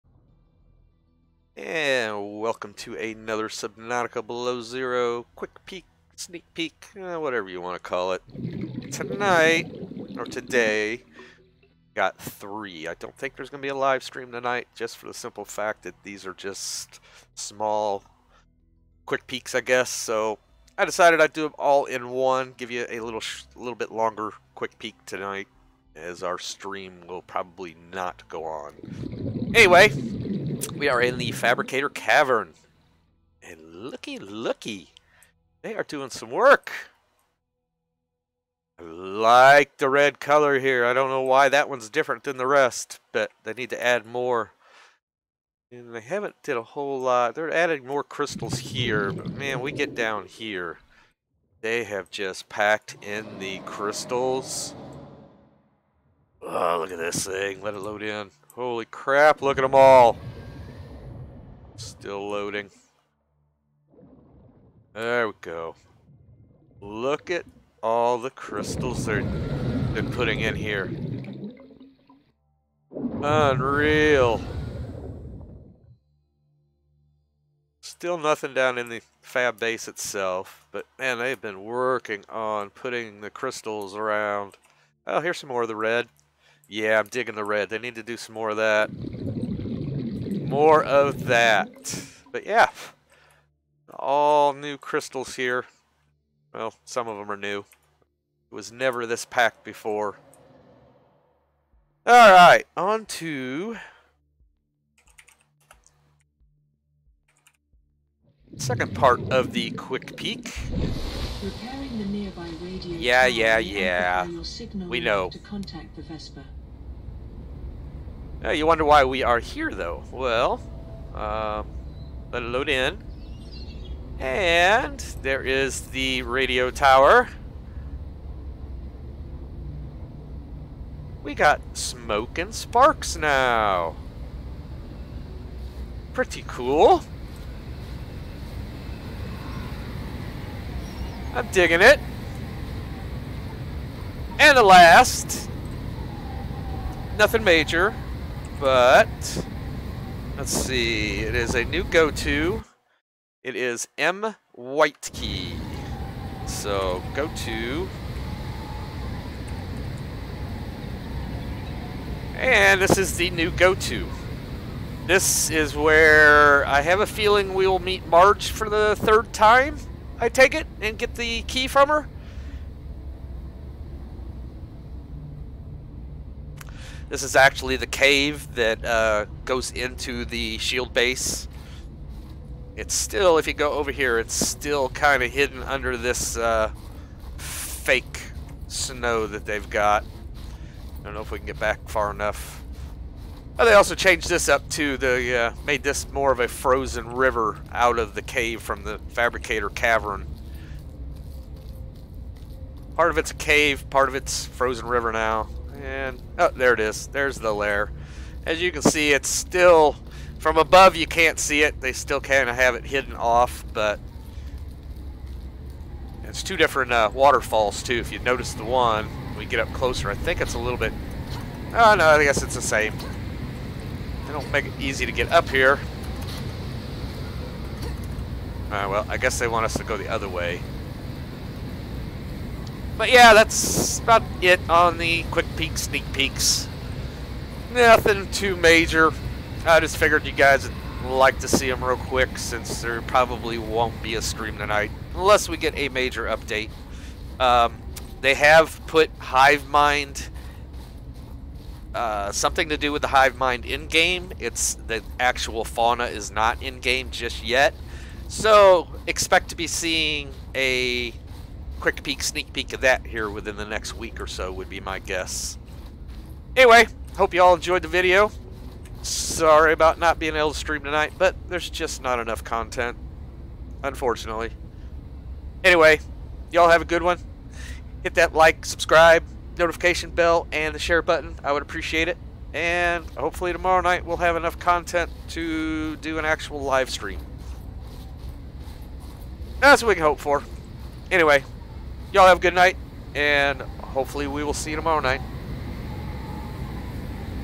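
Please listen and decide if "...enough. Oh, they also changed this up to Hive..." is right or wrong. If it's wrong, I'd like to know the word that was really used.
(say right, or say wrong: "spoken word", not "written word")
wrong: "They", not "Hive".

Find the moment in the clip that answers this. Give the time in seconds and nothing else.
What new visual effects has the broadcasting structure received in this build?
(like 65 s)
131 s.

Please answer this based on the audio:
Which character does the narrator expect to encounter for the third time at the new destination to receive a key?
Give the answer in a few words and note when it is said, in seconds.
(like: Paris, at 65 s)
Marge, at 168 s.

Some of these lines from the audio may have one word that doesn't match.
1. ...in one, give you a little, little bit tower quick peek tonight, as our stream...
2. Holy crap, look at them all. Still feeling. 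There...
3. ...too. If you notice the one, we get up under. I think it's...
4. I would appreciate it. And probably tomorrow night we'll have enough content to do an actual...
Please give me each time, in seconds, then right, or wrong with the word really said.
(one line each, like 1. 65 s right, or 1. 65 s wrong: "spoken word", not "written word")
1. 21 s wrong: "longer", not "tower"
2. 58 s wrong: "loading", not "feeling"
3. 217 s wrong: "closer", not "under"
4. 281 s wrong: "hopefully", not "probably".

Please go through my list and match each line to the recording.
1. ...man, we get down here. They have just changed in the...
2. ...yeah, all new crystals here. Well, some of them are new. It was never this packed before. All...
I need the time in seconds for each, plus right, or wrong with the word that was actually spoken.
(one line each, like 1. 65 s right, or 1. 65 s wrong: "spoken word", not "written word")
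1. 49 s wrong: "packed", not "changed"
2. 92 s right.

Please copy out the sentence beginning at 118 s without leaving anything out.
Yeah, you wonder why we are here, though.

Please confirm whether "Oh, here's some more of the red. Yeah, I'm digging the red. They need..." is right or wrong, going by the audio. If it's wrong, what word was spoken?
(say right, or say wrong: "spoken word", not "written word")
right.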